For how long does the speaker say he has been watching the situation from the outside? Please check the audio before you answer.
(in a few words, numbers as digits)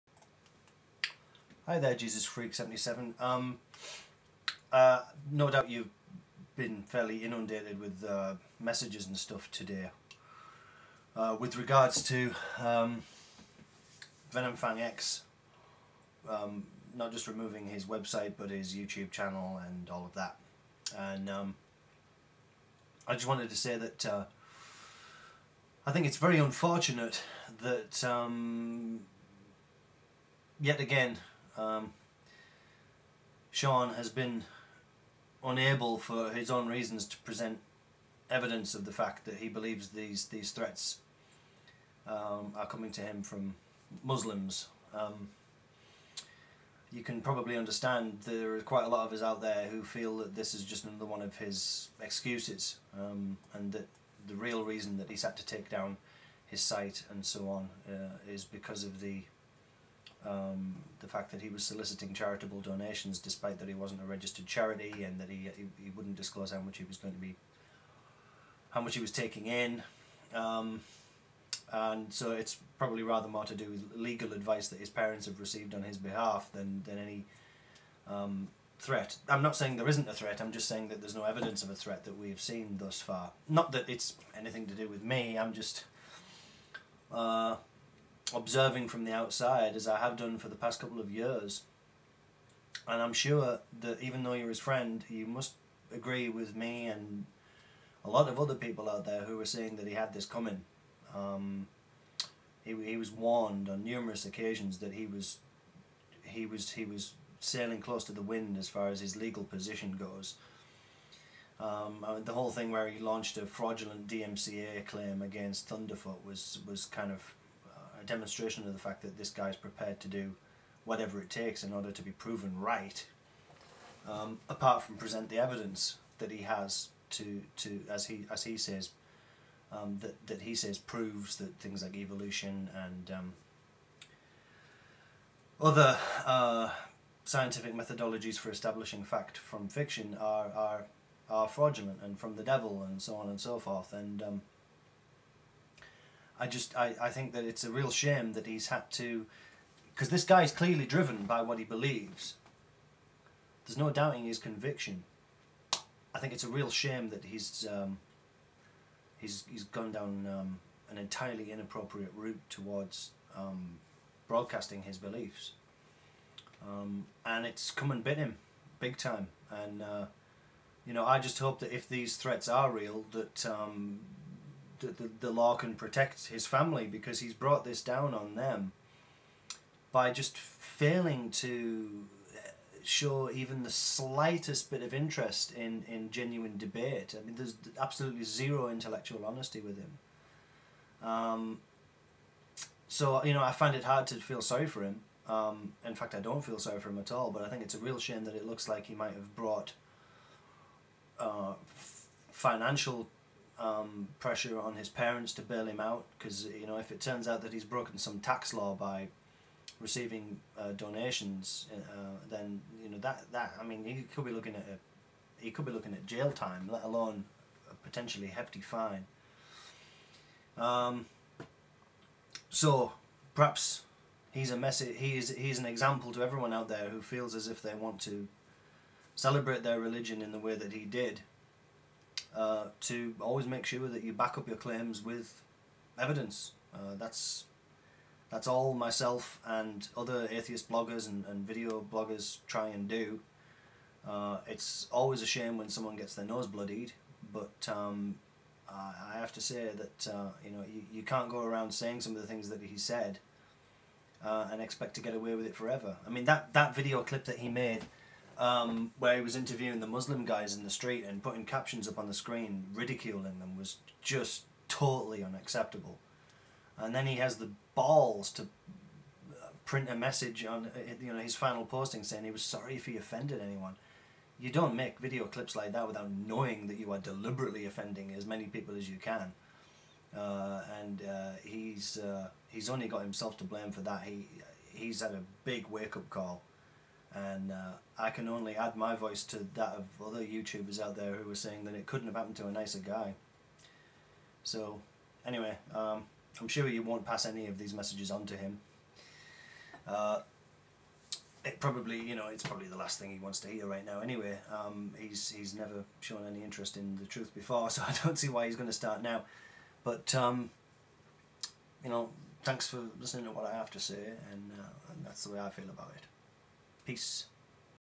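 2 years.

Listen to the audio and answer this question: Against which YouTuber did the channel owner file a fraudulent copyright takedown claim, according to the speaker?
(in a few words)
Thunderfoot.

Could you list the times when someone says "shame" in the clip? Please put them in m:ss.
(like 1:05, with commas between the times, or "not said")
2:27, 2:36, 3:17, 4:05.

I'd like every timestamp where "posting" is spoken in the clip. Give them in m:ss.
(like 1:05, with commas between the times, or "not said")
4:31.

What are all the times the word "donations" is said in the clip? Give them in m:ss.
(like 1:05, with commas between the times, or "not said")
1:02, 3:30.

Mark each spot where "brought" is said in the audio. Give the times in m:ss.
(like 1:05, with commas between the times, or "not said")
2:57, 3:19.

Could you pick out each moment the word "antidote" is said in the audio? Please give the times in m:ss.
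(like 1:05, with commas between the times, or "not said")
not said.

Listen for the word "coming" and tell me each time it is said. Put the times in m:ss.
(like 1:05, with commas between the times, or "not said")
0:42, 1:40.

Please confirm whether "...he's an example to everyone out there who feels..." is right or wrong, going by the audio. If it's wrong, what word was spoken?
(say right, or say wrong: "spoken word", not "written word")
right.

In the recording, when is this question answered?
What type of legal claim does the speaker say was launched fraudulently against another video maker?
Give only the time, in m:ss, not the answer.
1:54.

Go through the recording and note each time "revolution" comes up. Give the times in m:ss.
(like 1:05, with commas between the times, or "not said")
not said.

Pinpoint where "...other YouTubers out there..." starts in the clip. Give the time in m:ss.
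4:50.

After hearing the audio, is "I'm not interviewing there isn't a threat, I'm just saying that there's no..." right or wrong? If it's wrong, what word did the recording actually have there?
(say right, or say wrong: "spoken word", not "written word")
wrong: "saying", not "interviewing".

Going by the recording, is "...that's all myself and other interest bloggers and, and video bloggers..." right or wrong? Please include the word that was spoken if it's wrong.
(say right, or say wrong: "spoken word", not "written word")
wrong: "atheist", not "interest".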